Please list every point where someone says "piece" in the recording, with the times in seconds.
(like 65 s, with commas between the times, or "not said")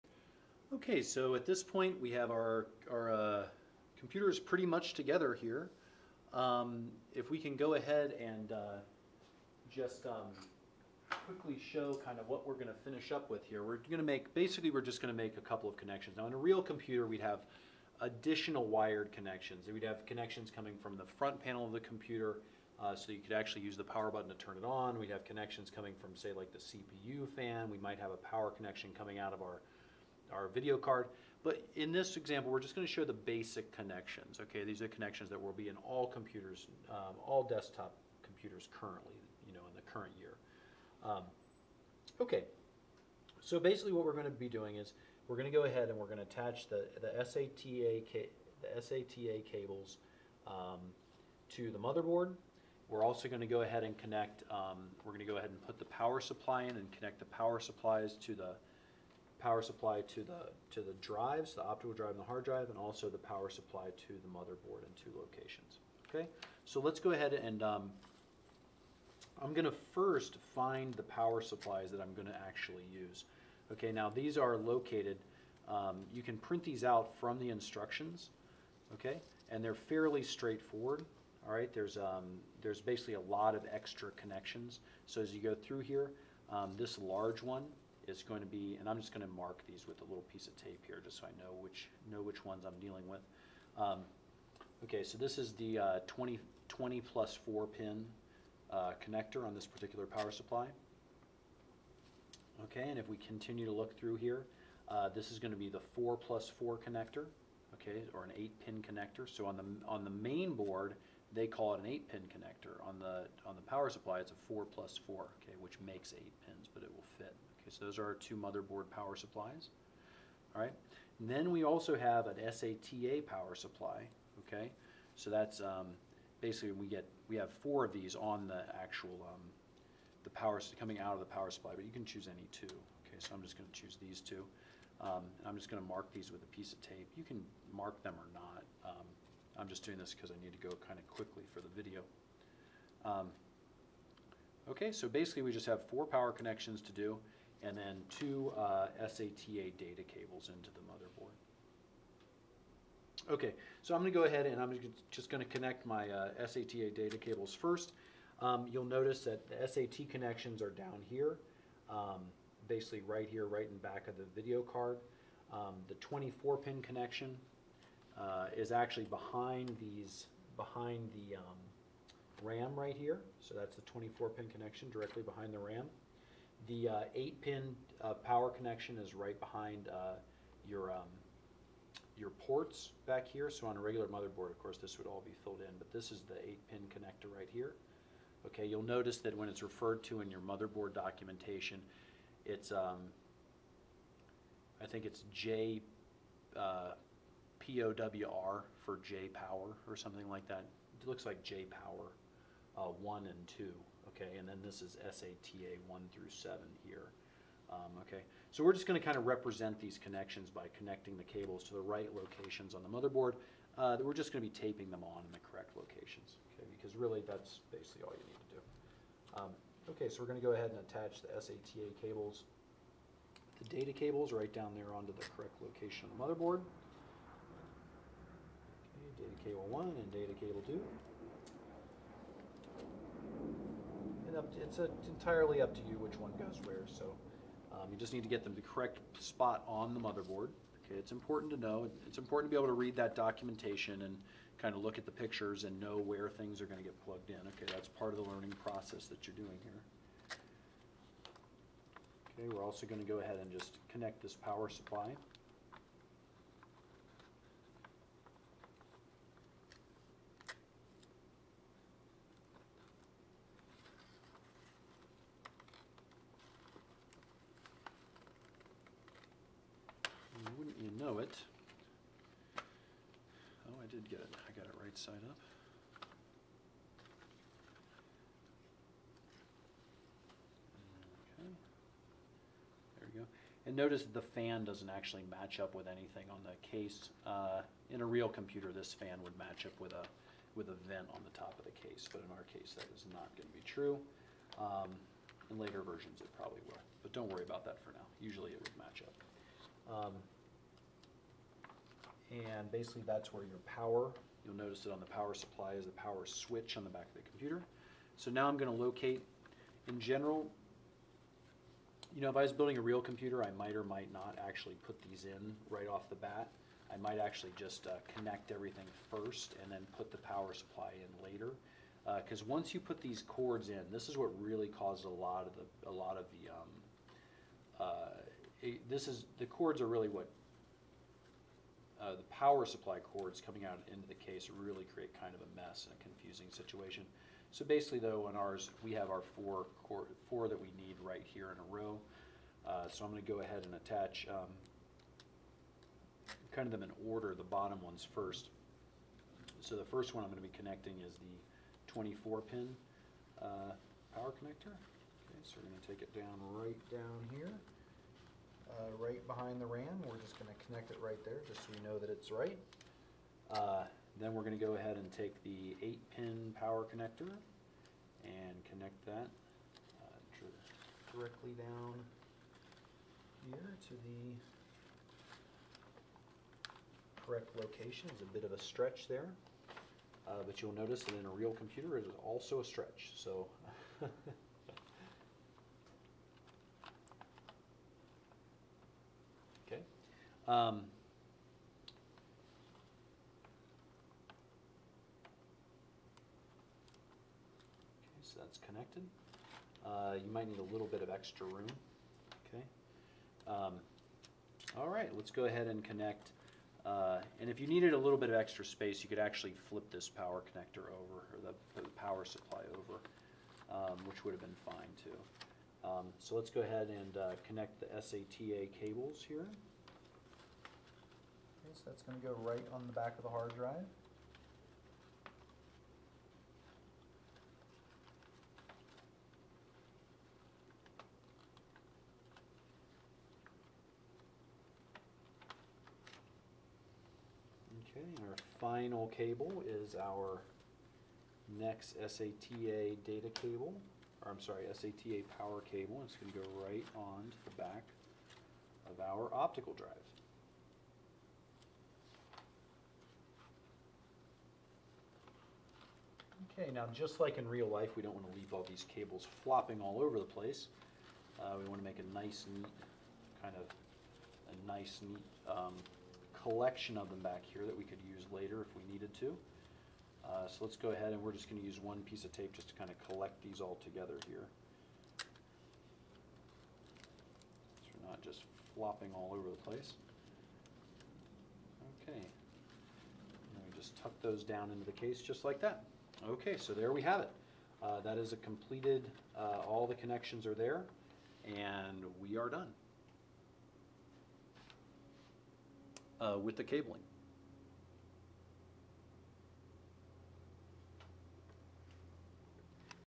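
90 s, 136 s, 472 s.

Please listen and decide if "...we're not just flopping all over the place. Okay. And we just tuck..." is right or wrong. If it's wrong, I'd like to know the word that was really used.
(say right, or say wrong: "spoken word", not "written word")
right.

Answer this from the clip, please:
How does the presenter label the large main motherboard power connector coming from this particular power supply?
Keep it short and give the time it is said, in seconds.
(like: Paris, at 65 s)
20 plus 4 pin, at 96 s.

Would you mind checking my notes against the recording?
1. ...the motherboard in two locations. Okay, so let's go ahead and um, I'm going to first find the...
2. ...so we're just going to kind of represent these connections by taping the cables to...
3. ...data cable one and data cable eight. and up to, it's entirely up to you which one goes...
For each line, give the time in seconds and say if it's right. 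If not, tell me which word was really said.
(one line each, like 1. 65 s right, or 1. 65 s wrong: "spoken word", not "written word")
1. 64 s right
2. 208 s wrong: "connecting", not "taping"
3. 229 s wrong: "two", not "eight".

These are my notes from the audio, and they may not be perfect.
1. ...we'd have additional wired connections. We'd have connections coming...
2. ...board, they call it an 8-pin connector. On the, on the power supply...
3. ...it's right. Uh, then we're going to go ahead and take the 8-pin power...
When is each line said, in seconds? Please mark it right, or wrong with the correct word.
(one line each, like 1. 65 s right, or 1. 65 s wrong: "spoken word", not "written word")
1. 17 s right
2. 110 s right
3. 362 s right.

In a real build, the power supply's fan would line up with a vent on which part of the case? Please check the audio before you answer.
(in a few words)
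the top.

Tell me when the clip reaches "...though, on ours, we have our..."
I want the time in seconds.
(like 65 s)
337 s.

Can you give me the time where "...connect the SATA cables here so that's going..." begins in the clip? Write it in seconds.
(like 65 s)
417 s.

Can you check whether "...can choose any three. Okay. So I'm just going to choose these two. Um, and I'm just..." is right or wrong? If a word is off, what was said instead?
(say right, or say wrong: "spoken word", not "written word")
wrong: "two", not "three".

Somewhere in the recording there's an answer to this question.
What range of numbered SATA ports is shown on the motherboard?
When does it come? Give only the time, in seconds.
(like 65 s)
205 s.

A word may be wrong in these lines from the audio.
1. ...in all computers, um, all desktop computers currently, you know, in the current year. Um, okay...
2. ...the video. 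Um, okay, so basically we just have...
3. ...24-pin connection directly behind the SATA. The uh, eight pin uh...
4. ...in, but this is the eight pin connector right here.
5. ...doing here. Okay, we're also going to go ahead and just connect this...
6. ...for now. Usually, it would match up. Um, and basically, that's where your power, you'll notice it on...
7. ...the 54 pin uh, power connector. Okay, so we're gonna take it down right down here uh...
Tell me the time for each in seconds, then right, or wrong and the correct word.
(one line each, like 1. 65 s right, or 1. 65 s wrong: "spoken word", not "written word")
1. 35 s right
2. 141 s right
3. 173 s wrong: "RAM", not "SATA"
4. 185 s right
5. 249 s right
6. 297 s right
7. 351 s wrong: "24", not "54".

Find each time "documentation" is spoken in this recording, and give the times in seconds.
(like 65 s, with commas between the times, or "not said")
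190 s, 243 s.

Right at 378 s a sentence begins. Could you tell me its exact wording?
It's a bit of a stretch there.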